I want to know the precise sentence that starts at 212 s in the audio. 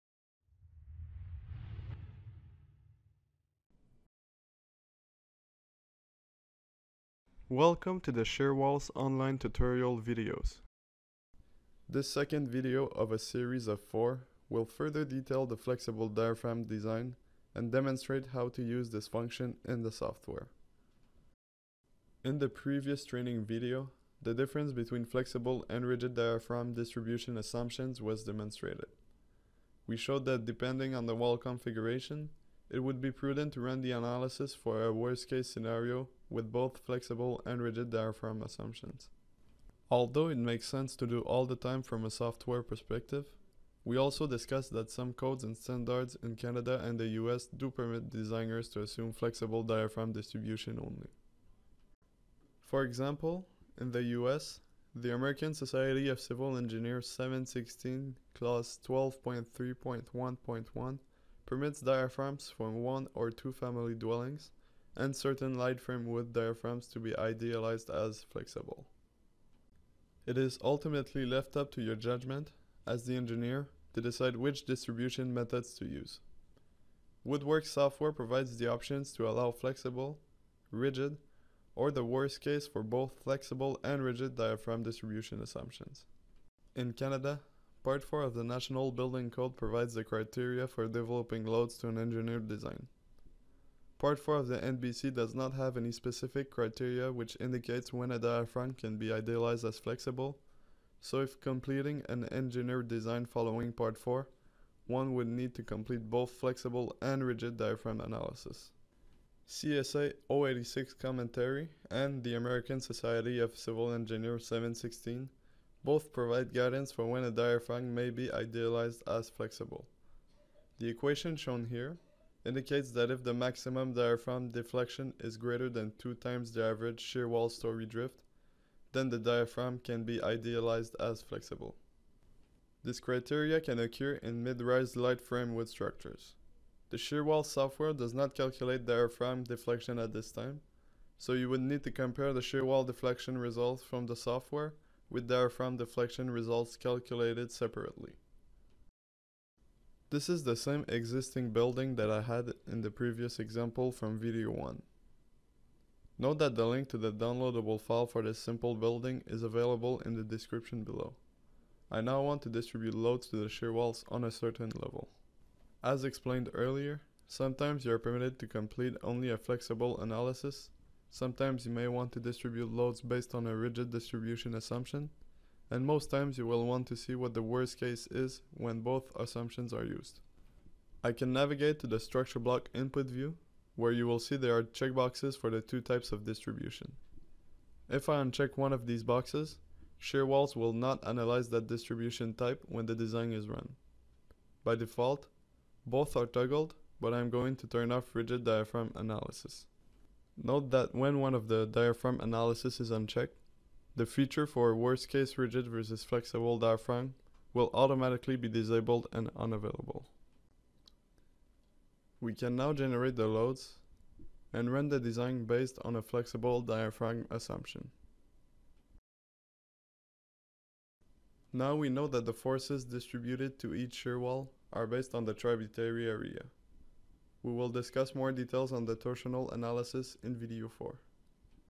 We can now generate the loads and run the design based on a flexible diaphragm assumption.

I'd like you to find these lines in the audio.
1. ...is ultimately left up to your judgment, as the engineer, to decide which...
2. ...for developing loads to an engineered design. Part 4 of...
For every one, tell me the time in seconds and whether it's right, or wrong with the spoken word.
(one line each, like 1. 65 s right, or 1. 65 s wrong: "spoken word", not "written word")
1. 70 s right
2. 90 s right.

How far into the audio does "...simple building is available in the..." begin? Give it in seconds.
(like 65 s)
158 s.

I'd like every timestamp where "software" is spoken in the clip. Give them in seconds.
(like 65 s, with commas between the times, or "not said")
19 s, 42 s, 77 s, 137 s, 144 s.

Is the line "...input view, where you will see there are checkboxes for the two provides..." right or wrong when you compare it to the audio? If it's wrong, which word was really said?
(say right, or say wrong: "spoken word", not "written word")
wrong: "types", not "provides".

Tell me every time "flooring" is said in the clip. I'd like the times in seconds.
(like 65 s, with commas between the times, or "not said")
not said.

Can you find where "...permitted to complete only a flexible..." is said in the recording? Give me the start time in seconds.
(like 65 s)
167 s.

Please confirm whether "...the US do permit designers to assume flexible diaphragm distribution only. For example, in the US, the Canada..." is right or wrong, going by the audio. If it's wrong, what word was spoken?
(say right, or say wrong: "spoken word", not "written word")
wrong: "American", not "Canada".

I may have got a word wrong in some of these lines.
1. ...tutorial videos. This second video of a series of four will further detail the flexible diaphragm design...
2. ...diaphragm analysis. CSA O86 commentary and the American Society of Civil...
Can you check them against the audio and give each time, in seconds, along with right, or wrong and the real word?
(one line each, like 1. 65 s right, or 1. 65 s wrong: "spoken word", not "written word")
1. 9 s right
2. 107 s right.